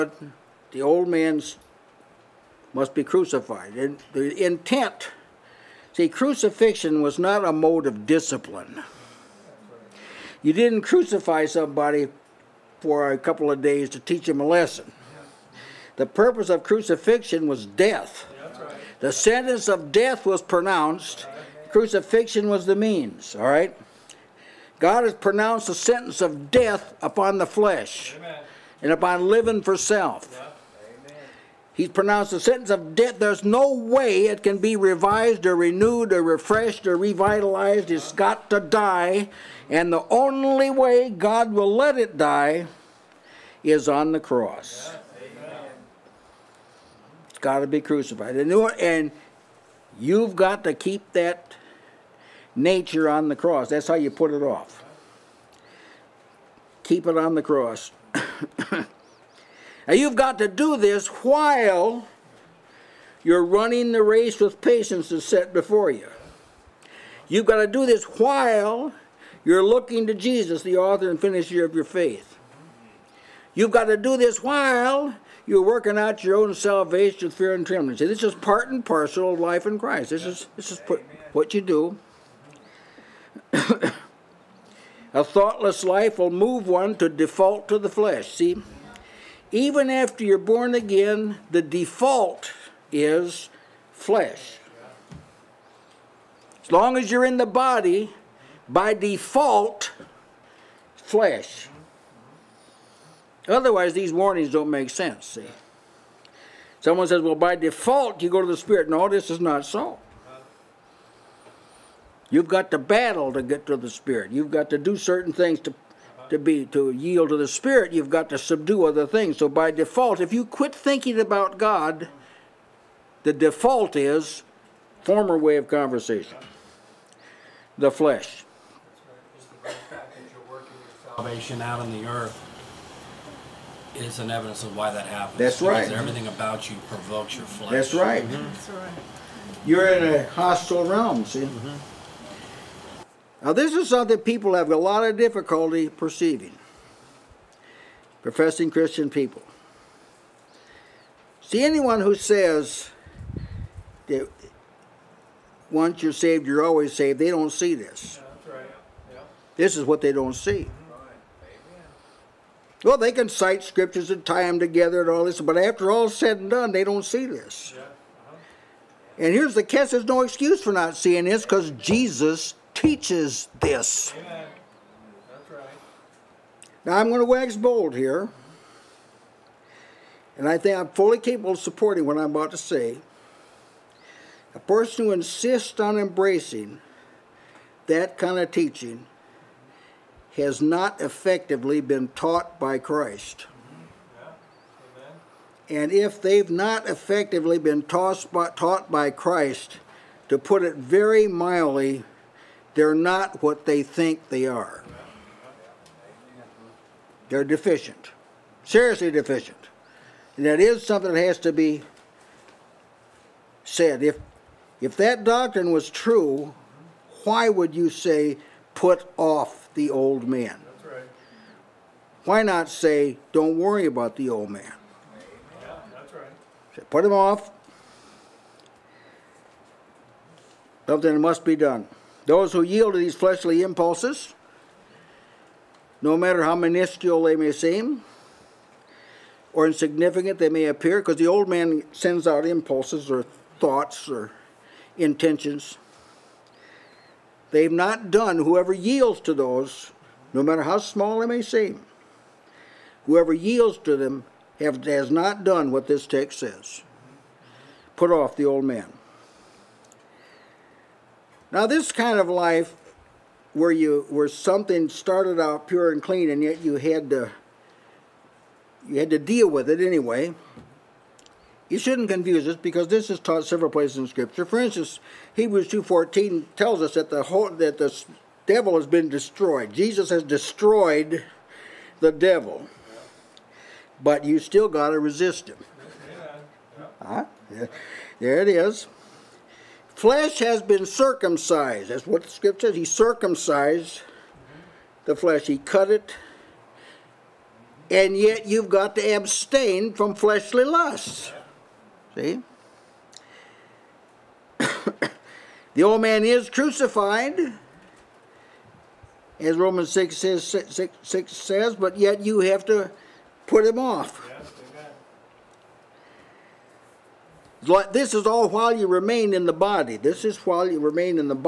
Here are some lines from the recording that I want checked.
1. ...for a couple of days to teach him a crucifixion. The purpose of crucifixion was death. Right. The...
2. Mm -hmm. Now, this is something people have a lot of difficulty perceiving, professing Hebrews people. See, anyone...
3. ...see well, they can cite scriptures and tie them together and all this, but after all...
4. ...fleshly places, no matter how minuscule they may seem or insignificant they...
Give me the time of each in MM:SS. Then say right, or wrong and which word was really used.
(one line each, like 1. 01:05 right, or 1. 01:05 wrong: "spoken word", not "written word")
1. 00:12 wrong: "lesson", not "crucifixion"
2. 02:21 wrong: "Christian", not "Hebrews"
3. 02:40 right
4. 03:53 wrong: "impulses", not "places".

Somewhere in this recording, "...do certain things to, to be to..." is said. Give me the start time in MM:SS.
01:54.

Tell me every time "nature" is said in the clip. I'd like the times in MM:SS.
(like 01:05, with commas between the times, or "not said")
00:52.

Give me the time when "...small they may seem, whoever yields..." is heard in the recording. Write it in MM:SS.
04:10.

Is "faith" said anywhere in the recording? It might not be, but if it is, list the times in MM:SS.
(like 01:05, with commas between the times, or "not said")
01:11.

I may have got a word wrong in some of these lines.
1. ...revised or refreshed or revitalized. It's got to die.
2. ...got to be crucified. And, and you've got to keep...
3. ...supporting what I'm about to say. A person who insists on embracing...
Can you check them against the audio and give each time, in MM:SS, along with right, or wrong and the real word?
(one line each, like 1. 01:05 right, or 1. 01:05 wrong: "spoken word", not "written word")
1. 00:35 wrong: "renewed", not "revised"
2. 00:47 right
3. 03:01 right.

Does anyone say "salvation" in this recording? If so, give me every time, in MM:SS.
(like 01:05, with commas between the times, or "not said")
01:16, 02:11.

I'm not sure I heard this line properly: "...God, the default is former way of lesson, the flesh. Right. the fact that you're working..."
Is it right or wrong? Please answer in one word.
wrong.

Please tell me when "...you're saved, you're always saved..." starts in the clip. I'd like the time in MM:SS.
02:36.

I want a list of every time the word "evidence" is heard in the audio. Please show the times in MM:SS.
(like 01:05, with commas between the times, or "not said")
02:14.